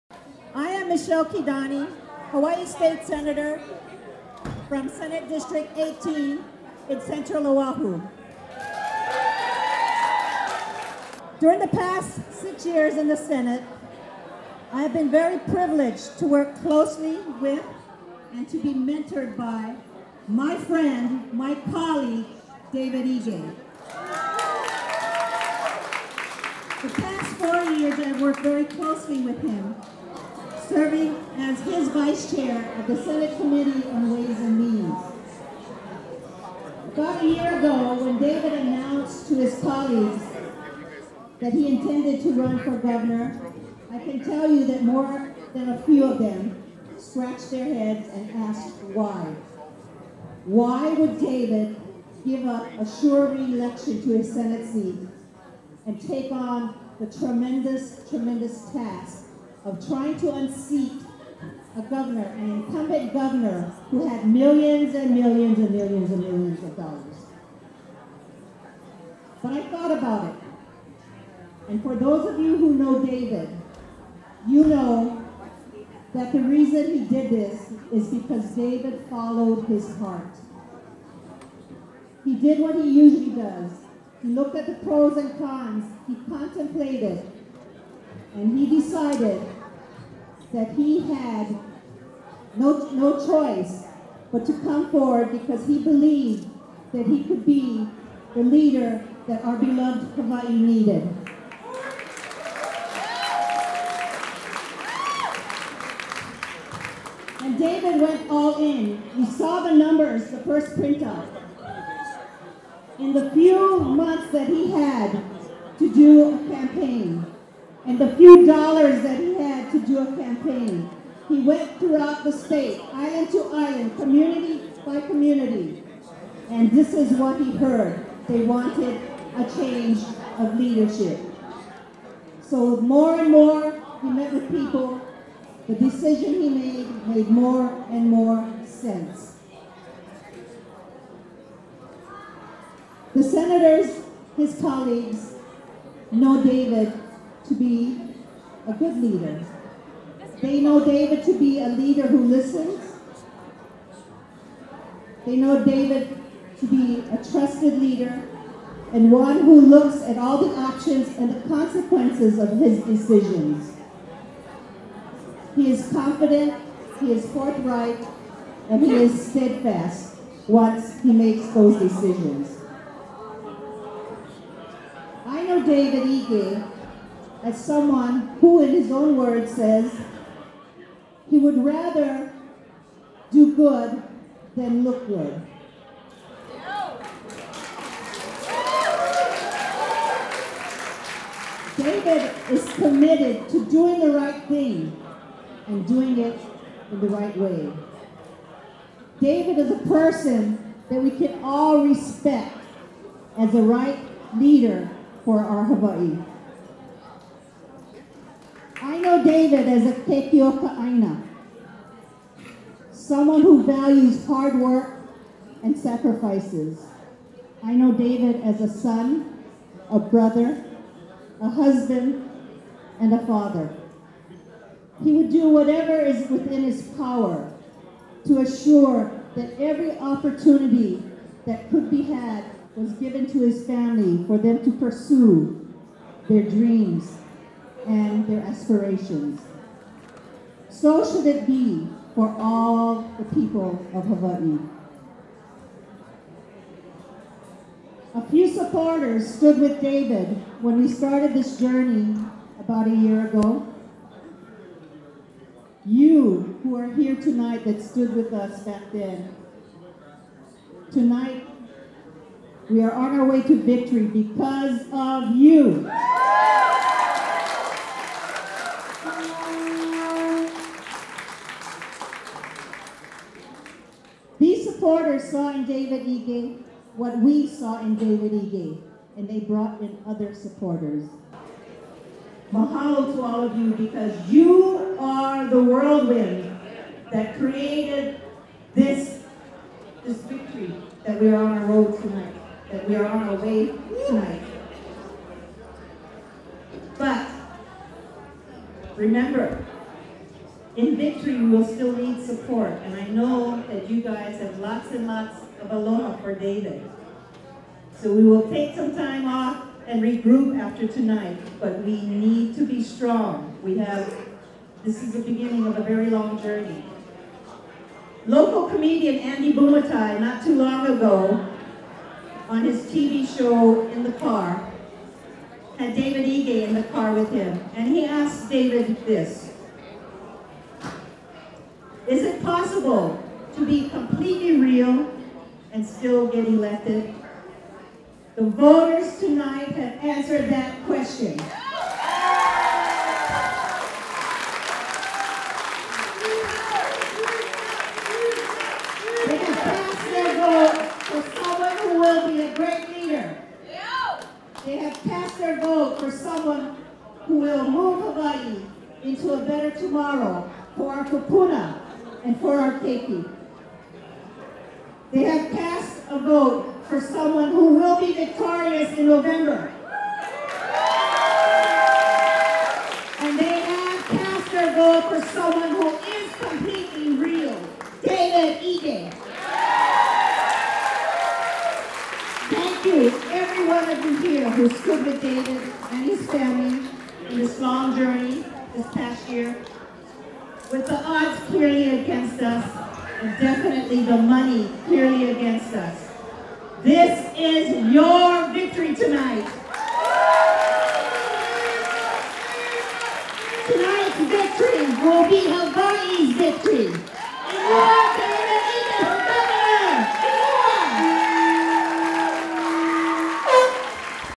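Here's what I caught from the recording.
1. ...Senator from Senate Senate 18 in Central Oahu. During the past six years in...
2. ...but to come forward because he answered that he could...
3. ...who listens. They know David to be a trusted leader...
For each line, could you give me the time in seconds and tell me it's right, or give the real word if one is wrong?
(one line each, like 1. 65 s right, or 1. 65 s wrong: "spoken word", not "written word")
1. 3 s wrong: "District", not "Senate"
2. 94 s wrong: "believed", not "answered"
3. 152 s right.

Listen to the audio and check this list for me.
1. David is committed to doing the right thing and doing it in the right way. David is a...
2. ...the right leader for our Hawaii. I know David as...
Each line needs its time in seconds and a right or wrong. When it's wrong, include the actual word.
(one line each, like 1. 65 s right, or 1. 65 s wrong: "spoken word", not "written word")
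1. 191 s right
2. 203 s right.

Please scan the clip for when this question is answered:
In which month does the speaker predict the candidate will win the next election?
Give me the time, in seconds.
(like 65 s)
369 s.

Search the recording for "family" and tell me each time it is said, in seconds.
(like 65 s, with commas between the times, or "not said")
233 s, 386 s.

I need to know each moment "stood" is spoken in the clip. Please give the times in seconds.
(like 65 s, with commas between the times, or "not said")
249 s, 257 s, 384 s.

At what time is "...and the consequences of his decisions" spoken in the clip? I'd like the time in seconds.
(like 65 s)
161 s.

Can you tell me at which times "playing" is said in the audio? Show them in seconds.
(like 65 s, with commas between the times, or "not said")
not said.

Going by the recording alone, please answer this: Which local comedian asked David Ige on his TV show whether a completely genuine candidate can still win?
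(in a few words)
Andy Bumatai.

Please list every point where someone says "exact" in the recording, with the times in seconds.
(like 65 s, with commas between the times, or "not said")
not said.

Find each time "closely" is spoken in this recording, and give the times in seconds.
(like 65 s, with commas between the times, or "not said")
16 s, 28 s.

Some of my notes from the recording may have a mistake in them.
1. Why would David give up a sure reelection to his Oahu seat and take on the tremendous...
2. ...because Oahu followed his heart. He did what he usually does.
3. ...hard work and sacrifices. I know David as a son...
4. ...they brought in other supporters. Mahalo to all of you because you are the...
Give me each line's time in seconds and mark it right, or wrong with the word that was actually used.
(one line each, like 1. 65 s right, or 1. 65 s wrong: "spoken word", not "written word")
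1. 50 s wrong: "Senate", not "Oahu"
2. 78 s wrong: "David", not "Oahu"
3. 214 s right
4. 279 s right.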